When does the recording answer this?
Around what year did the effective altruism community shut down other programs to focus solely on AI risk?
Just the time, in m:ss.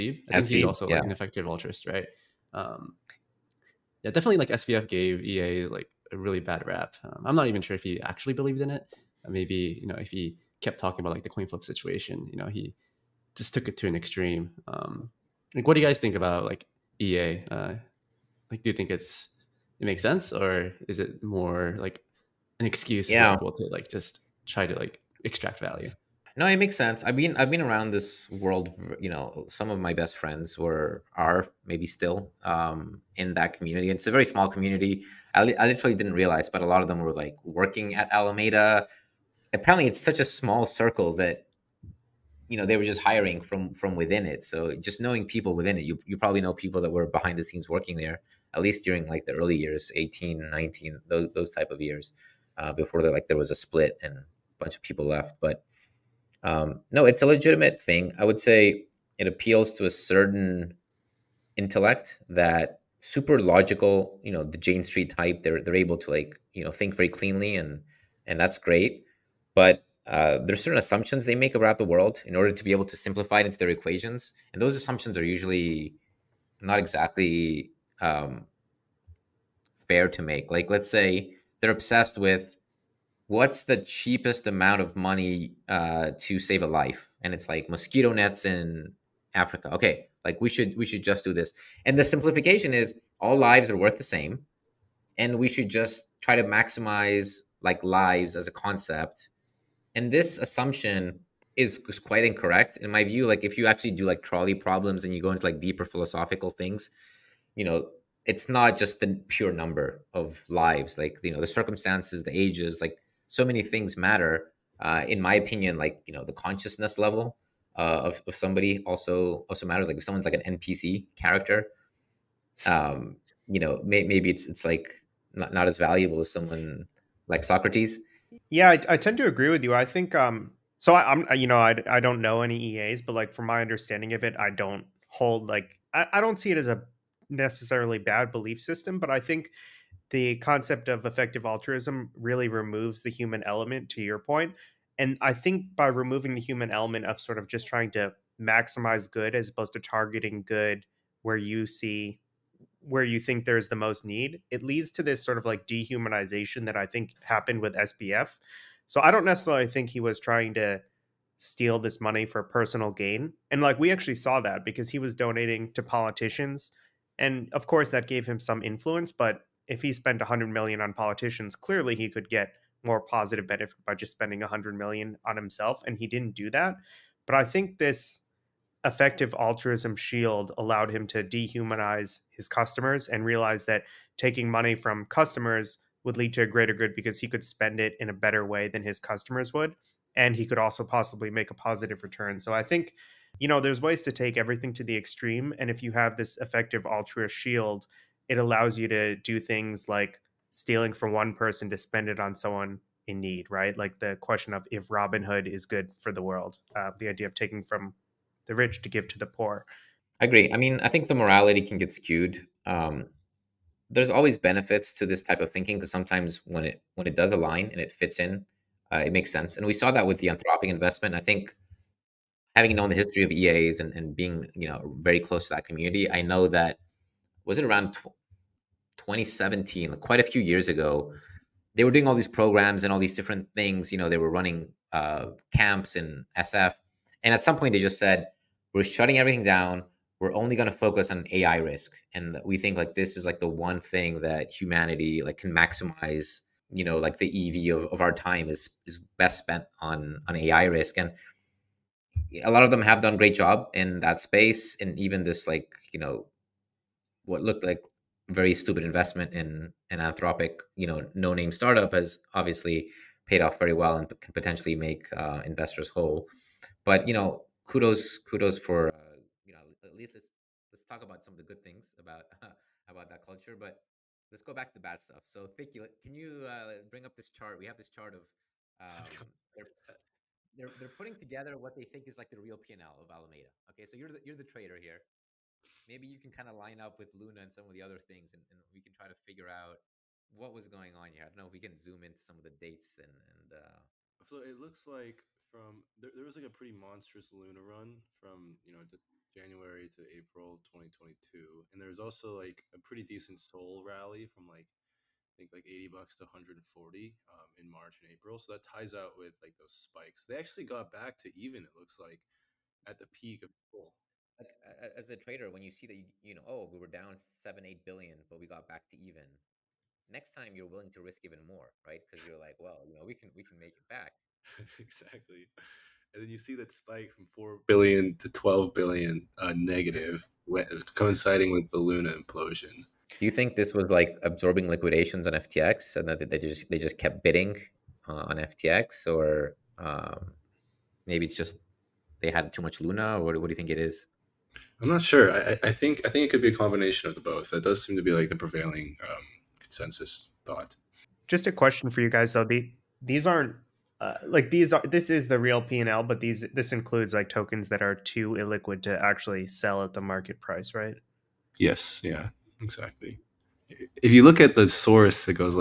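3:48.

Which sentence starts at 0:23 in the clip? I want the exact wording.
for people to like just try to like extract value?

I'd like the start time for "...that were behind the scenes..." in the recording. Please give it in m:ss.
0:46.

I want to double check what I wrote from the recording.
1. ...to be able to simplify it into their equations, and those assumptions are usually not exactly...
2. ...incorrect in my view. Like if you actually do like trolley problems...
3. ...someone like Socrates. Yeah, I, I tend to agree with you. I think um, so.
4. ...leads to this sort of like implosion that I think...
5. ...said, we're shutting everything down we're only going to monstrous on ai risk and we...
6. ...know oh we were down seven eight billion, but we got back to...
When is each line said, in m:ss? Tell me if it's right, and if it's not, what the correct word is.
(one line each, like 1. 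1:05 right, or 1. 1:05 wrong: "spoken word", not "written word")
1. 1:12 right
2. 1:42 right
3. 2:06 right
4. 2:34 wrong: "dehumanization", not "implosion"
5. 3:57 wrong: "focus", not "monstrous"
6. 5:16 right.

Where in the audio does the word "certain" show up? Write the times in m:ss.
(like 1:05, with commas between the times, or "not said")
0:59, 1:10.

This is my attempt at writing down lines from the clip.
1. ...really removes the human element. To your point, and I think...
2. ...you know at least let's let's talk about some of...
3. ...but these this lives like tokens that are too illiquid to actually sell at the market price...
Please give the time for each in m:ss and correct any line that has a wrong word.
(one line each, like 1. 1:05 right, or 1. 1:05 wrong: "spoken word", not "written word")
1. 2:22 right
2. 4:29 right
3. 5:56 wrong: "includes", not "lives".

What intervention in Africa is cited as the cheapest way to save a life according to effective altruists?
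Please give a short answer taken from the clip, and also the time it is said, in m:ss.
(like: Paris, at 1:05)
Mosquito nets, at 1:27.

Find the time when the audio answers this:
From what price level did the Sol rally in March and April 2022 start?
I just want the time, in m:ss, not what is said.
5:05.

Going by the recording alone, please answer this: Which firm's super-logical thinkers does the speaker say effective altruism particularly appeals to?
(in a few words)
Jane Street.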